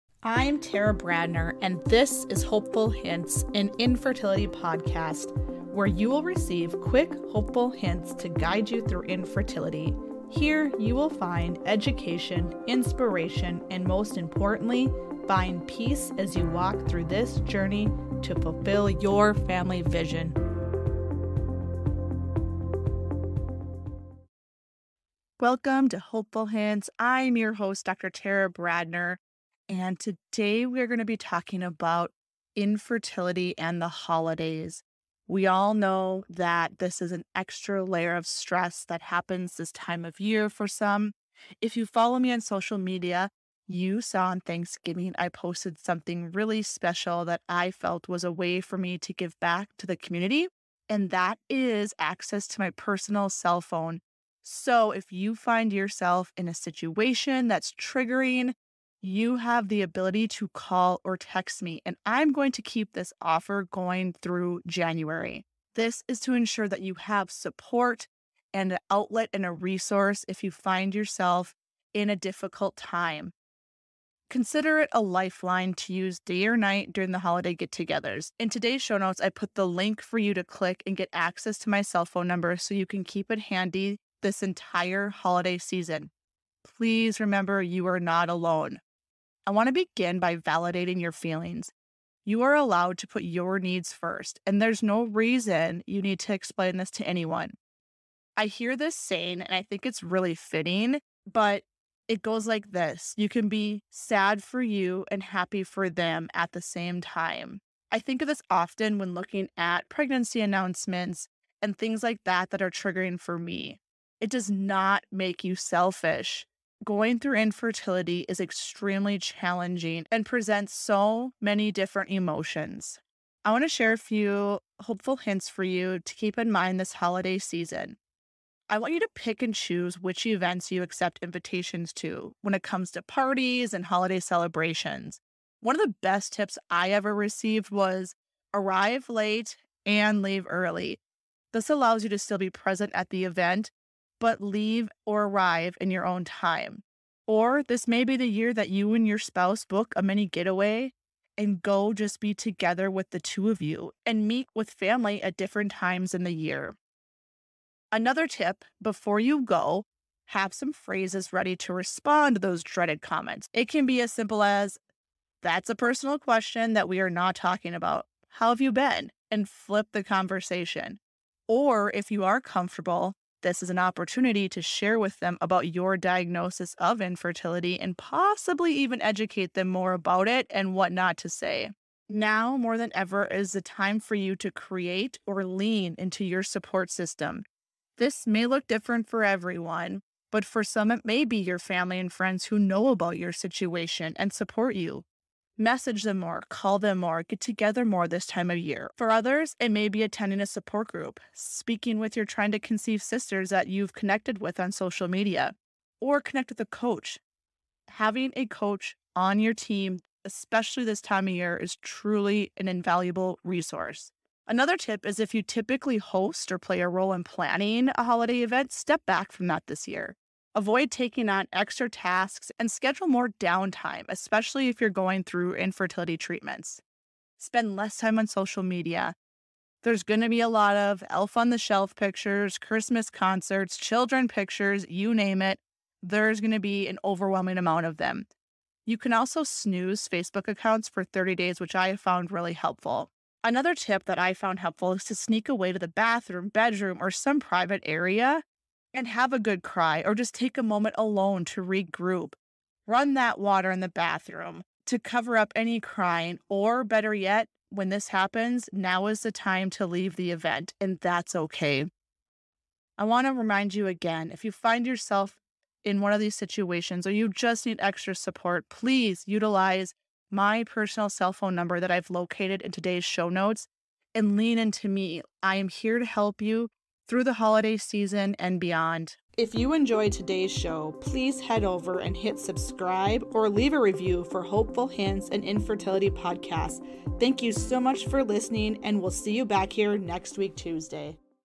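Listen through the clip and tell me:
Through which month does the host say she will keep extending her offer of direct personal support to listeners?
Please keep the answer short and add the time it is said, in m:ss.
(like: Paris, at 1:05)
January, at 1:04.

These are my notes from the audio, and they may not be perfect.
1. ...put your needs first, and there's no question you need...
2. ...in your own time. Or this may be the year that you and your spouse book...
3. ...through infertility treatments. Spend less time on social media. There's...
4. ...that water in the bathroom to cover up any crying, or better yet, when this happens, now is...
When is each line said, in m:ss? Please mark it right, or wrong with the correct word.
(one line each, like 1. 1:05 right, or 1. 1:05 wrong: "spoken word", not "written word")
1. 1:33 wrong: "reason", not "question"
2. 2:25 right
3. 3:45 right
4. 4:13 right.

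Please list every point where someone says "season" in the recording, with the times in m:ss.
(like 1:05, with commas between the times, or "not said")
1:25, 2:07, 4:37.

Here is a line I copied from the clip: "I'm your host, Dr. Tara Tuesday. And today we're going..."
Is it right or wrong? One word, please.
wrong.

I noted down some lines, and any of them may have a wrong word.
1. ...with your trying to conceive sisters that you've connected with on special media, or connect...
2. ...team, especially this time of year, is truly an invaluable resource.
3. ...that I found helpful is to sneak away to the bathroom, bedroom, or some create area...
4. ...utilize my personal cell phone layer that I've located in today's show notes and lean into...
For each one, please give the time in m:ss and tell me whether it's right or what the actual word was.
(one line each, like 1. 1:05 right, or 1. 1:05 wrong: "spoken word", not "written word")
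1. 3:21 wrong: "social", not "special"
2. 3:29 right
3. 4:04 wrong: "private", not "create"
4. 4:29 wrong: "number", not "layer".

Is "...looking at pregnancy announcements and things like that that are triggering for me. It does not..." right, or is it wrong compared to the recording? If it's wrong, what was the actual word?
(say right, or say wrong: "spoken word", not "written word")
right.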